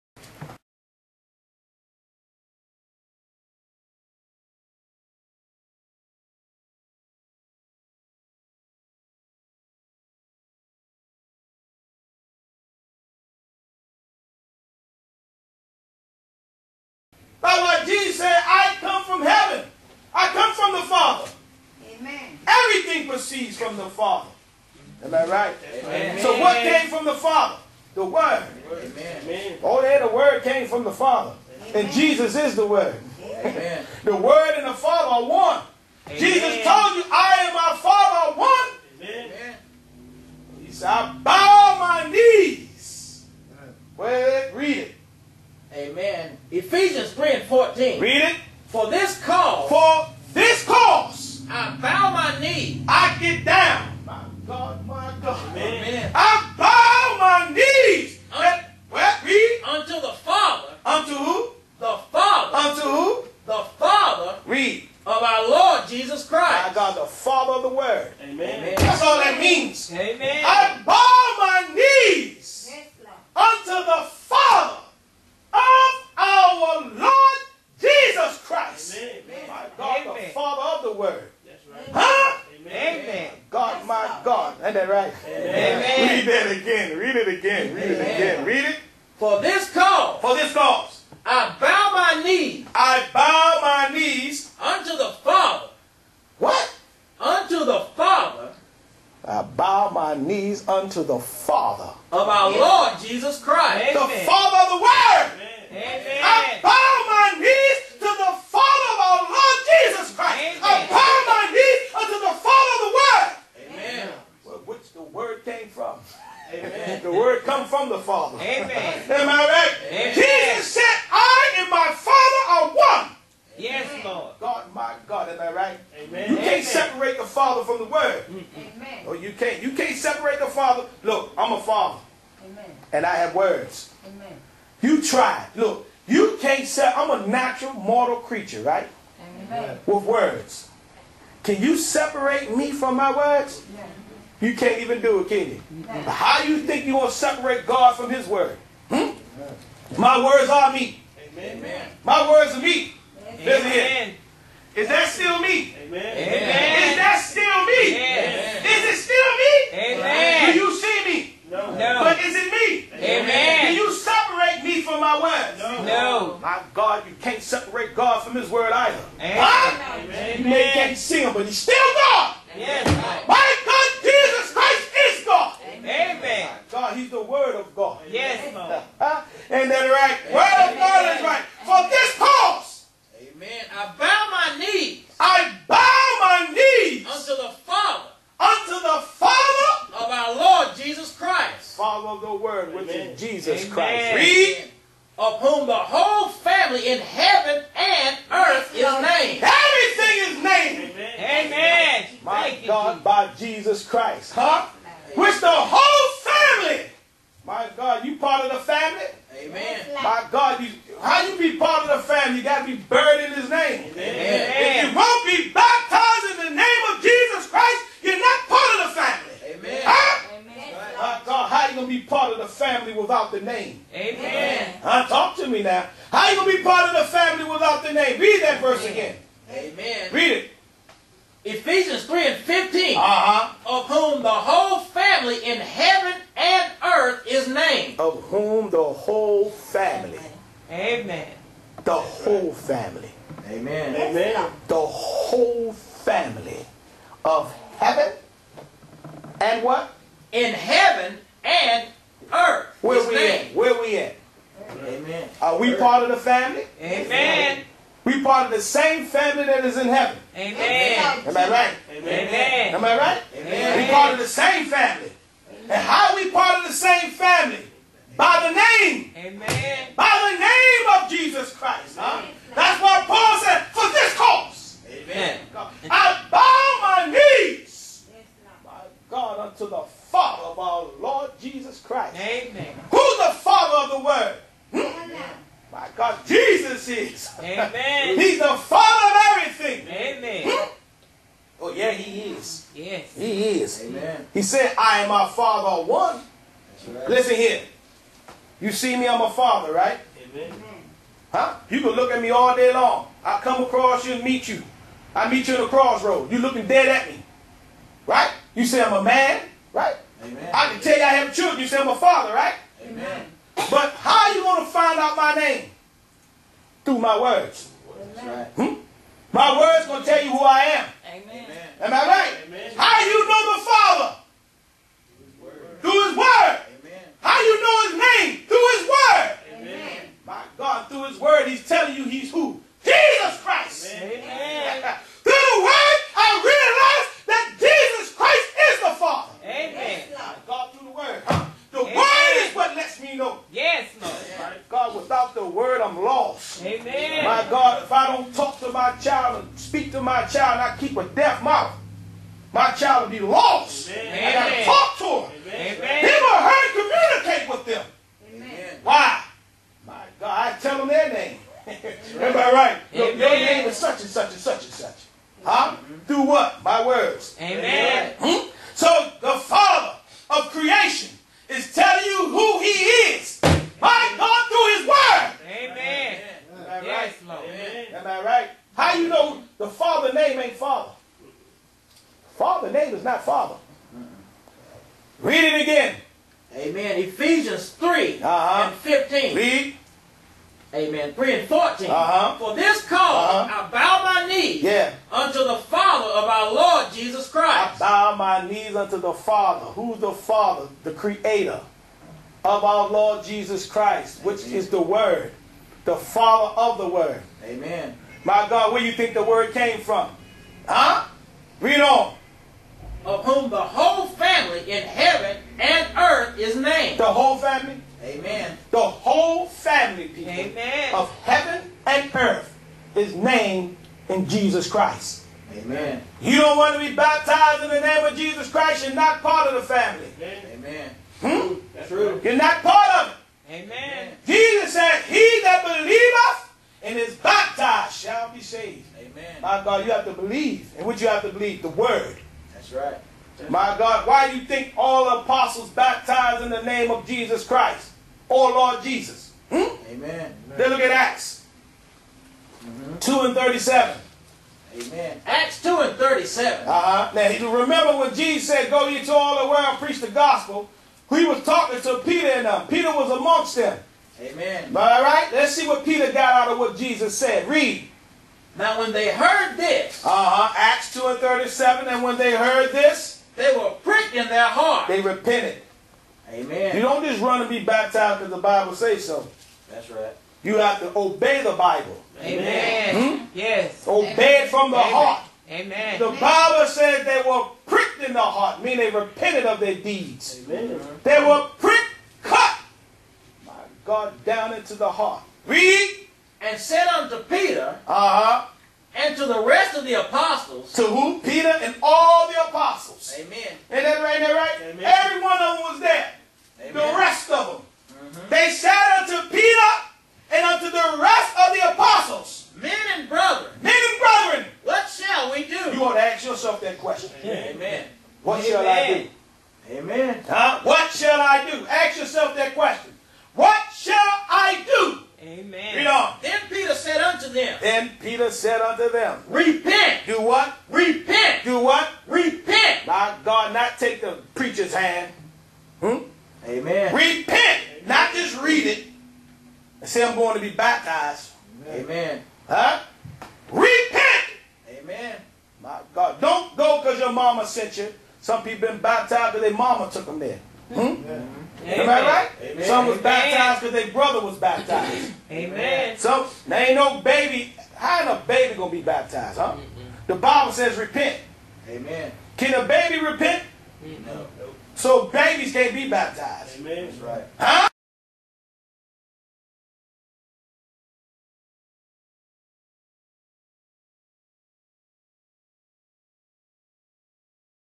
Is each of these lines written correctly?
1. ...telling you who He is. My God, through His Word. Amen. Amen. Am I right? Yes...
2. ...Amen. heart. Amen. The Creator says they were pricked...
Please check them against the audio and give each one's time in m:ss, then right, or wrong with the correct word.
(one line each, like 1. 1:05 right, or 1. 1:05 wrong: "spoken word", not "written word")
1. 6:11 right
2. 8:04 wrong: "Bible", not "Creator".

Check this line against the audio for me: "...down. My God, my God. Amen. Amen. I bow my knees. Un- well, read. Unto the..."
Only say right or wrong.
right.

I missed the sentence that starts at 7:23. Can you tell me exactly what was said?
That's My God, why do you think all apostles baptized in the name of Jesus Christ or oh, Lord Jesus?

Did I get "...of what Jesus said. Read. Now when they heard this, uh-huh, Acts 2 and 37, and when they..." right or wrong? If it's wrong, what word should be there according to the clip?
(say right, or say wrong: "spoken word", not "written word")
right.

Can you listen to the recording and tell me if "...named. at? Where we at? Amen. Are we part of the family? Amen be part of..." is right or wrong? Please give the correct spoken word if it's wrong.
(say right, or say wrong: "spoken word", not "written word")
right.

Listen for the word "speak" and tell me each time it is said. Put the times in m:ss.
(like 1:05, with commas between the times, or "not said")
5:49.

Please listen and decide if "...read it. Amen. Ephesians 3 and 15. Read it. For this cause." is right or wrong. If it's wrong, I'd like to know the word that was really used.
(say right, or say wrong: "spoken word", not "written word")
wrong: "14", not "15".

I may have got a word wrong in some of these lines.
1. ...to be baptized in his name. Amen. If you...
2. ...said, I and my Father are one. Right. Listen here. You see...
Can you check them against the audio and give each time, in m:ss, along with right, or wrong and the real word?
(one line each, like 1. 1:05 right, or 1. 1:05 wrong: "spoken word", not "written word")
1. 3:32 wrong: "buried", not "baptized"
2. 4:54 right.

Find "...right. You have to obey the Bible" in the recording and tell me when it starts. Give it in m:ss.
7:59.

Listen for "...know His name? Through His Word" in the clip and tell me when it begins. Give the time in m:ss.
5:27.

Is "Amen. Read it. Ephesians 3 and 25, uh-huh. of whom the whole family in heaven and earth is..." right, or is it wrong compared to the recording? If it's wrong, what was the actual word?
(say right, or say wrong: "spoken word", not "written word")
wrong: "15", not "25".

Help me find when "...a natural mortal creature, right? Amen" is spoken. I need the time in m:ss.
2:17.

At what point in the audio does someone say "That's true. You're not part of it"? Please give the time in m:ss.
7:11.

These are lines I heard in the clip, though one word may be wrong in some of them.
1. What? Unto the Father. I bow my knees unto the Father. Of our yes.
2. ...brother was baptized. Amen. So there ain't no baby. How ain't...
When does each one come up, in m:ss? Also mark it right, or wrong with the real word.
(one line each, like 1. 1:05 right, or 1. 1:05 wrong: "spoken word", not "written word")
1. 1:36 right
2. 9:13 right.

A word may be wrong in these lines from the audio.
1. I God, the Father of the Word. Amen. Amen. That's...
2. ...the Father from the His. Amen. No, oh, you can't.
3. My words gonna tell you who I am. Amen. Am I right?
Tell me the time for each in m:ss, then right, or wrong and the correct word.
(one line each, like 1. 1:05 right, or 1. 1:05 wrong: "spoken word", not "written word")
1. 1:06 right
2. 2:07 wrong: "Word", not "His"
3. 5:19 right.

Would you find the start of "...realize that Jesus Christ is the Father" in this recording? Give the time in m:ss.
5:36.